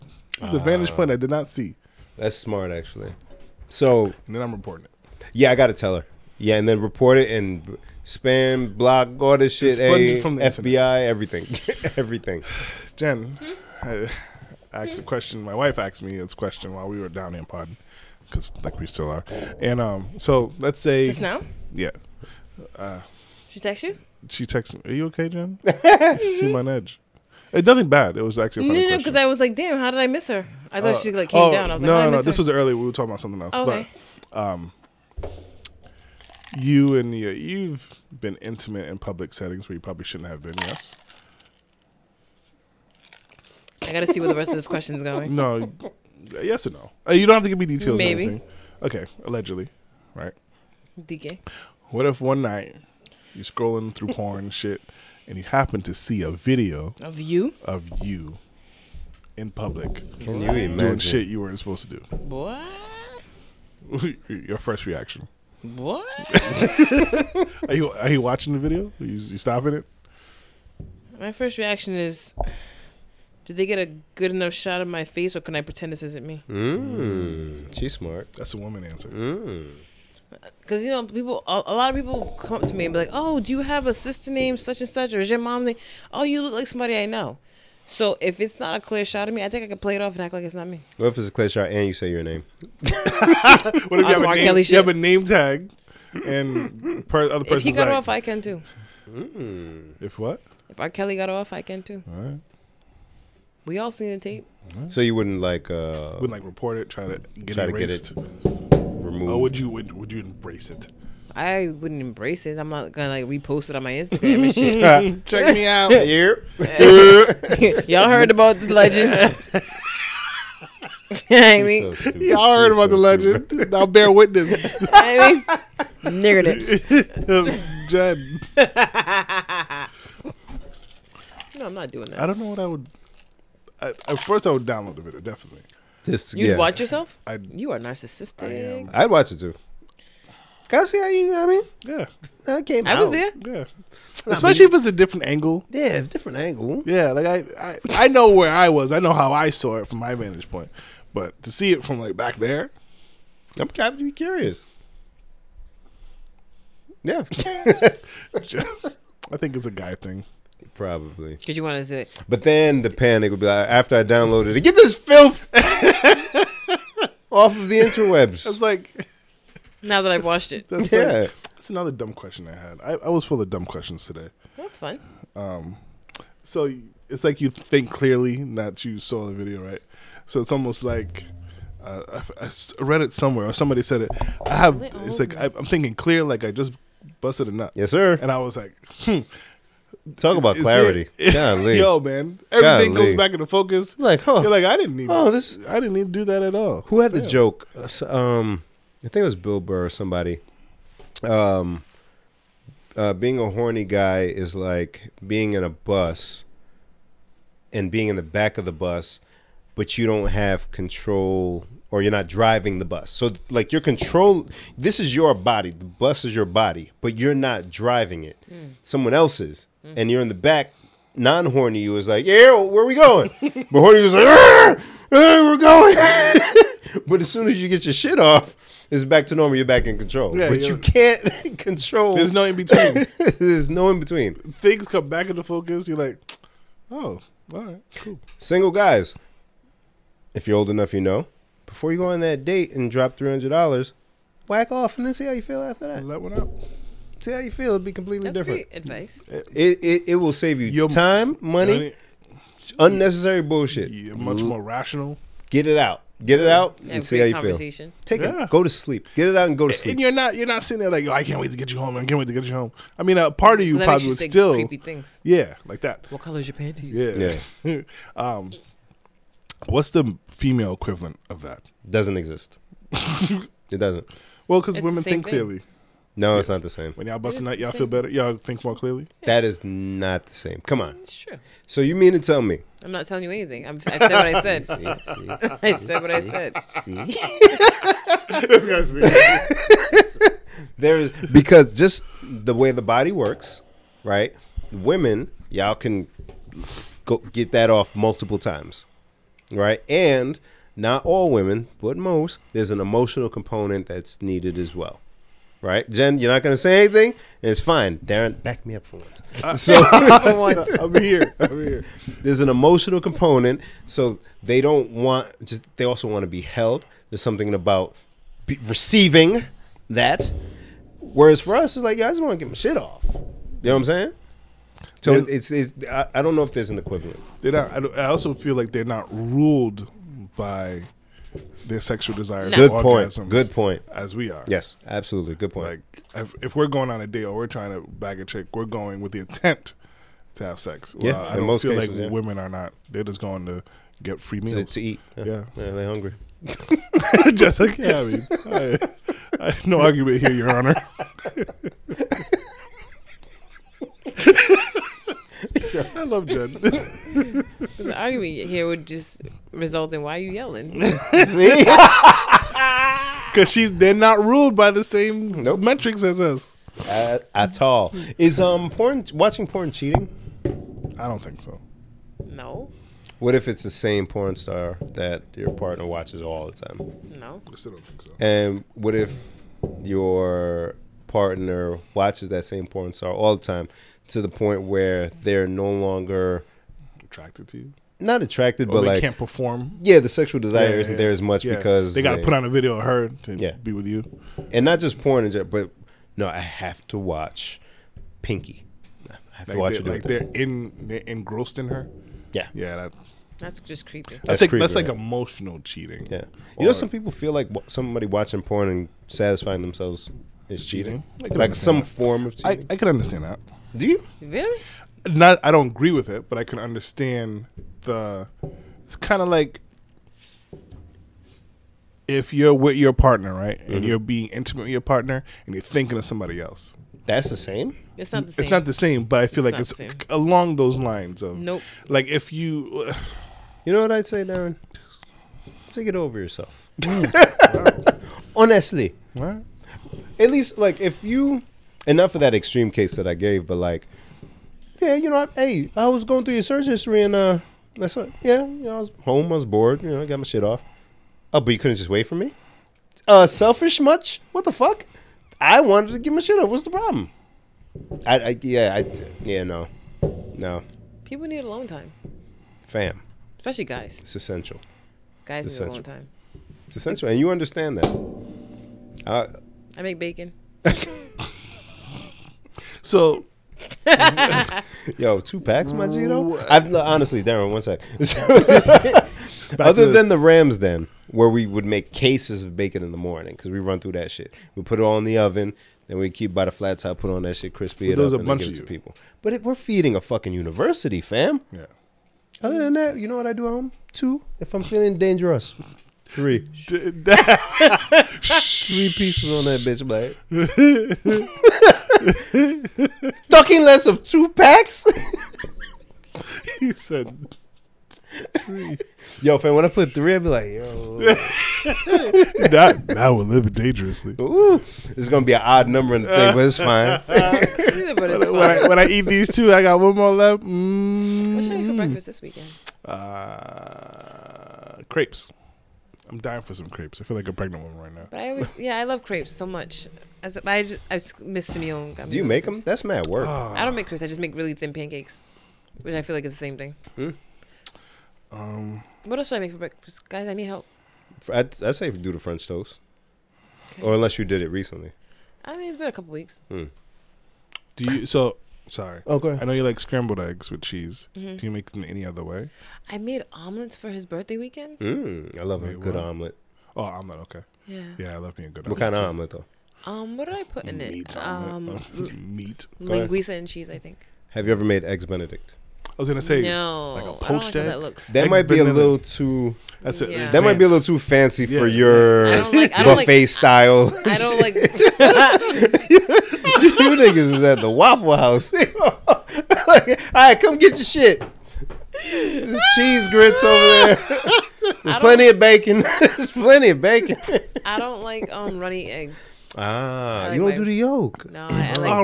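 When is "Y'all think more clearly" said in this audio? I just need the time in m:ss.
4:38.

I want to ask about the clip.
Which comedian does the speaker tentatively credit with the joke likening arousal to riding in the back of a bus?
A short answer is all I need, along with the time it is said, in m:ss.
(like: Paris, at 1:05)
Bill Burr, at 3:19.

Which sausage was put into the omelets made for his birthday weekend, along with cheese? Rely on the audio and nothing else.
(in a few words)
Linguiça.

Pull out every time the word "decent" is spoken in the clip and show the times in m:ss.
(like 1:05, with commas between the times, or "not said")
not said.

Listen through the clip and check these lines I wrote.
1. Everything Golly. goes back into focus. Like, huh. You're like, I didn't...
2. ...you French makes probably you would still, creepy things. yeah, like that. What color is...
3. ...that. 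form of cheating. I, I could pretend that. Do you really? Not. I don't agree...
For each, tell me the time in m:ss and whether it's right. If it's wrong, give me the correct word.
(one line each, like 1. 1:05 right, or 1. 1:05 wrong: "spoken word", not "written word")
1. 3:12 right
2. 4:23 wrong: "That", not "French"
3. 6:51 wrong: "understand", not "pretend".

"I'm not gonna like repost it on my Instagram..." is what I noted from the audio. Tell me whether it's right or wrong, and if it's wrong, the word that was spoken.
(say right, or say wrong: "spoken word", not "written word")
right.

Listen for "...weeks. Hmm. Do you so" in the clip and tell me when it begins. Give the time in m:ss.
9:06.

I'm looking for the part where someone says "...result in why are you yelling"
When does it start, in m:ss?
5:59.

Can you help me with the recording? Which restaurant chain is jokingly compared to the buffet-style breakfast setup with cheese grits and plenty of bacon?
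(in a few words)
Waffle House.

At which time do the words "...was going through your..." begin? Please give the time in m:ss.
7:25.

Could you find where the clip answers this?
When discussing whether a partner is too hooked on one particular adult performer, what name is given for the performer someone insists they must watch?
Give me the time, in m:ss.
6:38.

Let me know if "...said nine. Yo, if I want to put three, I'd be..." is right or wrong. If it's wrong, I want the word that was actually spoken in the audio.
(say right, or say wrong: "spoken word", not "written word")
wrong: "three", not "nine".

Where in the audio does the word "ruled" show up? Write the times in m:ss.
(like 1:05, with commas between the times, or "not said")
5:29, 6:04.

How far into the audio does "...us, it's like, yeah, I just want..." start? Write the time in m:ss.
5:21.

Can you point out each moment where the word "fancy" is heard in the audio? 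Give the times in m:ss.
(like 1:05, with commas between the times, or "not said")
9:30.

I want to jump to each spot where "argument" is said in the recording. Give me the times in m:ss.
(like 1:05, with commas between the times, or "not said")
5:49, 5:57.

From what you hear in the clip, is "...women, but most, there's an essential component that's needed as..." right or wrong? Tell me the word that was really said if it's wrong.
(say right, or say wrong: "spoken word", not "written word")
wrong: "emotional", not "essential".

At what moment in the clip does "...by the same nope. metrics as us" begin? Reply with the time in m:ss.
6:04.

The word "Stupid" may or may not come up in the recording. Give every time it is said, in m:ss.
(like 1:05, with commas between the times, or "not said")
2:03.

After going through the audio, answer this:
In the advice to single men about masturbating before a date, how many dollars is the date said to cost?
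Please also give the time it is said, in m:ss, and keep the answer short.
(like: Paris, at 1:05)
300, at 4:03.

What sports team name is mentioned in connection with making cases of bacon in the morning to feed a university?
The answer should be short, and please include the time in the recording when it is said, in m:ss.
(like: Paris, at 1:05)
Rams, at 8:00.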